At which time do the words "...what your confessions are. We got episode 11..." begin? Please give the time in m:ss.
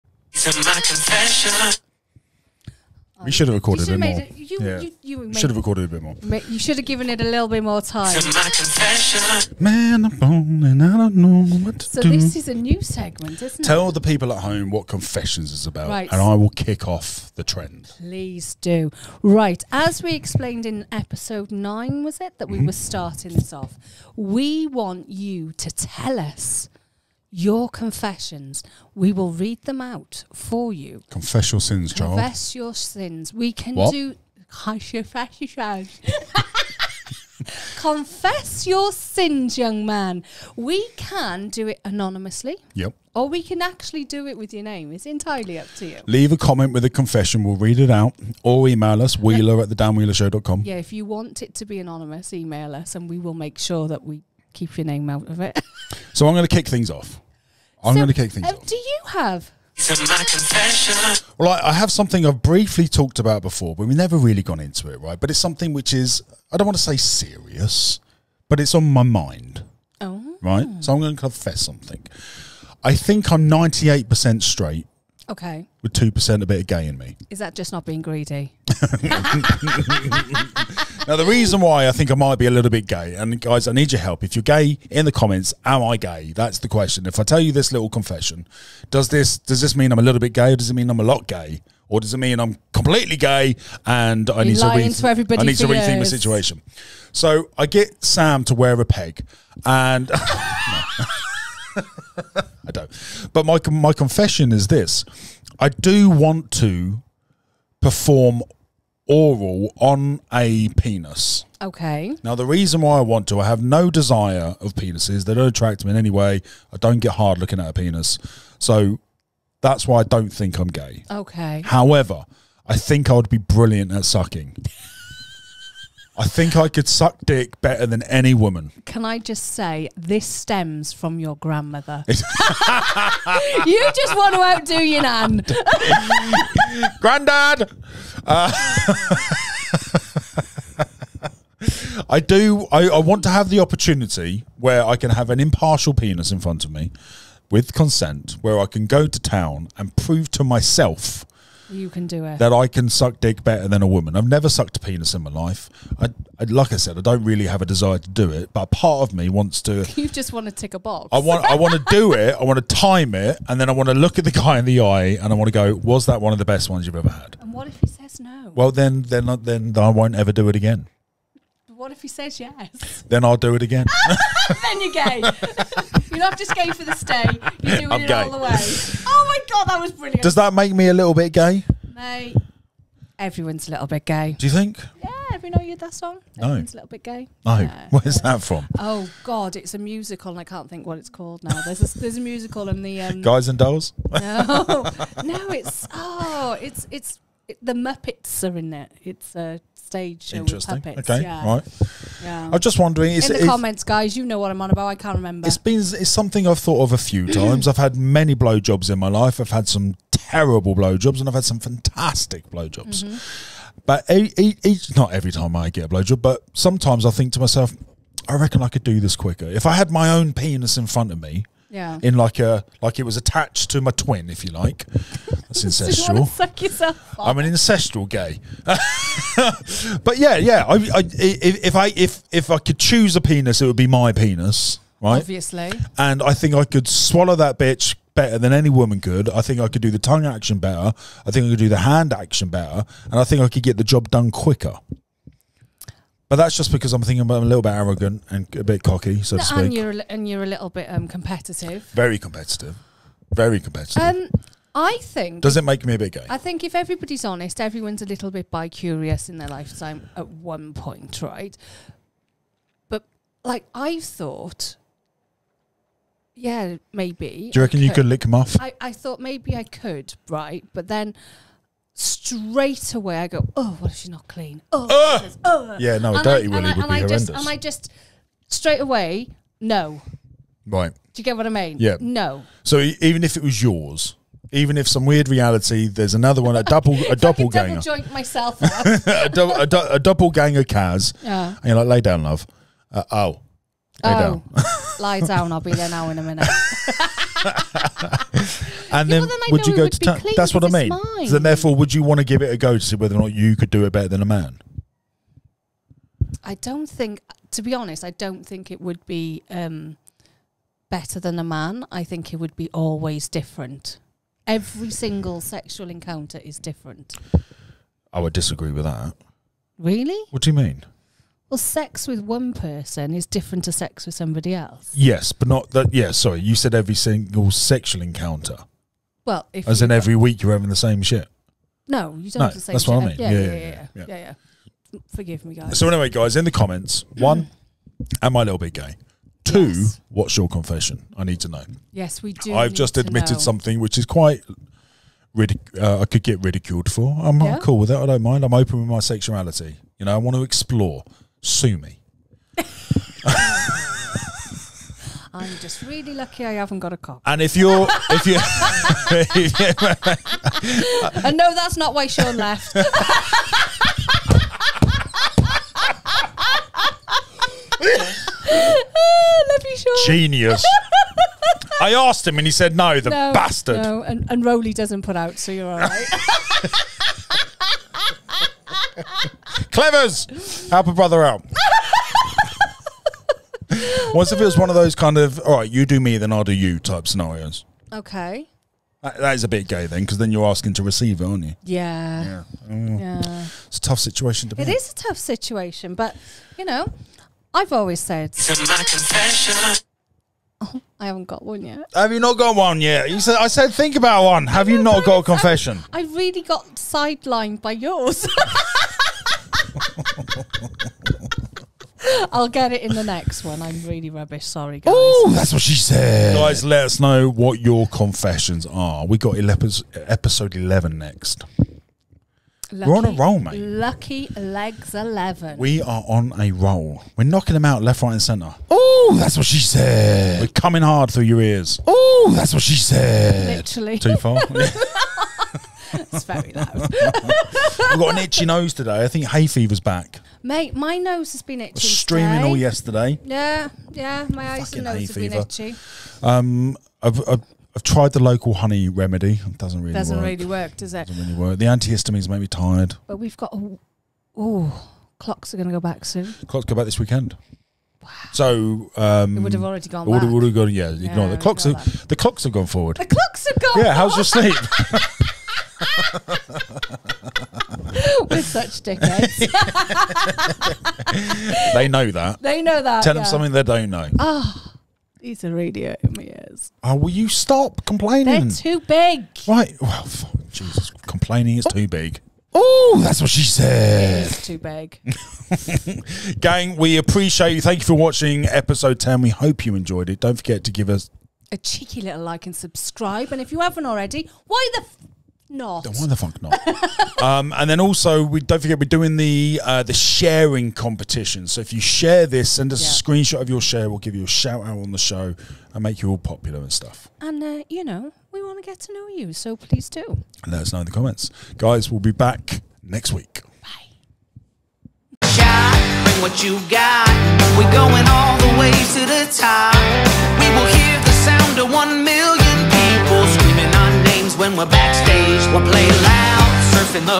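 6:57.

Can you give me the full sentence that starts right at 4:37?
just, and I just straight away, no.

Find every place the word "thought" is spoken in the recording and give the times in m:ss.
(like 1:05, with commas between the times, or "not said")
3:26, 4:24, 4:28.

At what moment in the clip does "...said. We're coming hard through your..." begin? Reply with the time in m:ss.
7:09.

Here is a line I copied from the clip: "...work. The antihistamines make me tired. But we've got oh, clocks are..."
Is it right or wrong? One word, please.
right.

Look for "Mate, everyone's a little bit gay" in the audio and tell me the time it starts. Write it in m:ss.
3:01.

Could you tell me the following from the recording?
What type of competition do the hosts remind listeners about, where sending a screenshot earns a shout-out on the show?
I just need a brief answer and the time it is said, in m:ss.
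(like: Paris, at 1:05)
Sharing competition, at 8:19.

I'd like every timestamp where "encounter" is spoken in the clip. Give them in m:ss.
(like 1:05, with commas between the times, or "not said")
5:15, 5:28.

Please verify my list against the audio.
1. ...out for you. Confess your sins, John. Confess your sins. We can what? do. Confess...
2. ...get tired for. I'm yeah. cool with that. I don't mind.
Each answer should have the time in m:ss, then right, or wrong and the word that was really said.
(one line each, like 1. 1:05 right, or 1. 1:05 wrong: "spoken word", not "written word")
1. 0:29 right
2. 5:46 wrong: "ridiculed", not "tired".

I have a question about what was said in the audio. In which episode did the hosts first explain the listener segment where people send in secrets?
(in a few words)
Episode 9.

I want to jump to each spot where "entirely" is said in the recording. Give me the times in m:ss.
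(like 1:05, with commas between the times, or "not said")
0:45.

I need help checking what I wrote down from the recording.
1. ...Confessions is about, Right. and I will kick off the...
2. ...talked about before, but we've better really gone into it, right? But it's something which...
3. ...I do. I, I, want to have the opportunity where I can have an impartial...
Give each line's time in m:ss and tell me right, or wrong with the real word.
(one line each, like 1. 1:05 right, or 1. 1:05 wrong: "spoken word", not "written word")
1. 0:14 right
2. 1:02 wrong: "never", not "better"
3. 2:22 right.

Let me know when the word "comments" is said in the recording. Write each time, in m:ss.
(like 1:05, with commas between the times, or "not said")
0:46, 1:25, 3:23, 5:36, 8:30.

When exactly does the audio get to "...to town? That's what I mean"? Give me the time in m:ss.
4:59.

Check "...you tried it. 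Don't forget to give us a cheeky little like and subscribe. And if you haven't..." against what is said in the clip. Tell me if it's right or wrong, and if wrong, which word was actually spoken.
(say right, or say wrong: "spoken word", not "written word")
wrong: "enjoyed", not "tried".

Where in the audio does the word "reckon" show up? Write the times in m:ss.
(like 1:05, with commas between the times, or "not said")
3:38, 4:27.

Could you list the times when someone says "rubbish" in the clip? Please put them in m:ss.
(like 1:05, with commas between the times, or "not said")
6:54.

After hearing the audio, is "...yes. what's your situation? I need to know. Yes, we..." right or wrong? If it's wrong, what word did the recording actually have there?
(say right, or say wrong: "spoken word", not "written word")
wrong: "confession", not "situation".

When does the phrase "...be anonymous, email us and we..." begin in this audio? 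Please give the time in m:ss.
0:51.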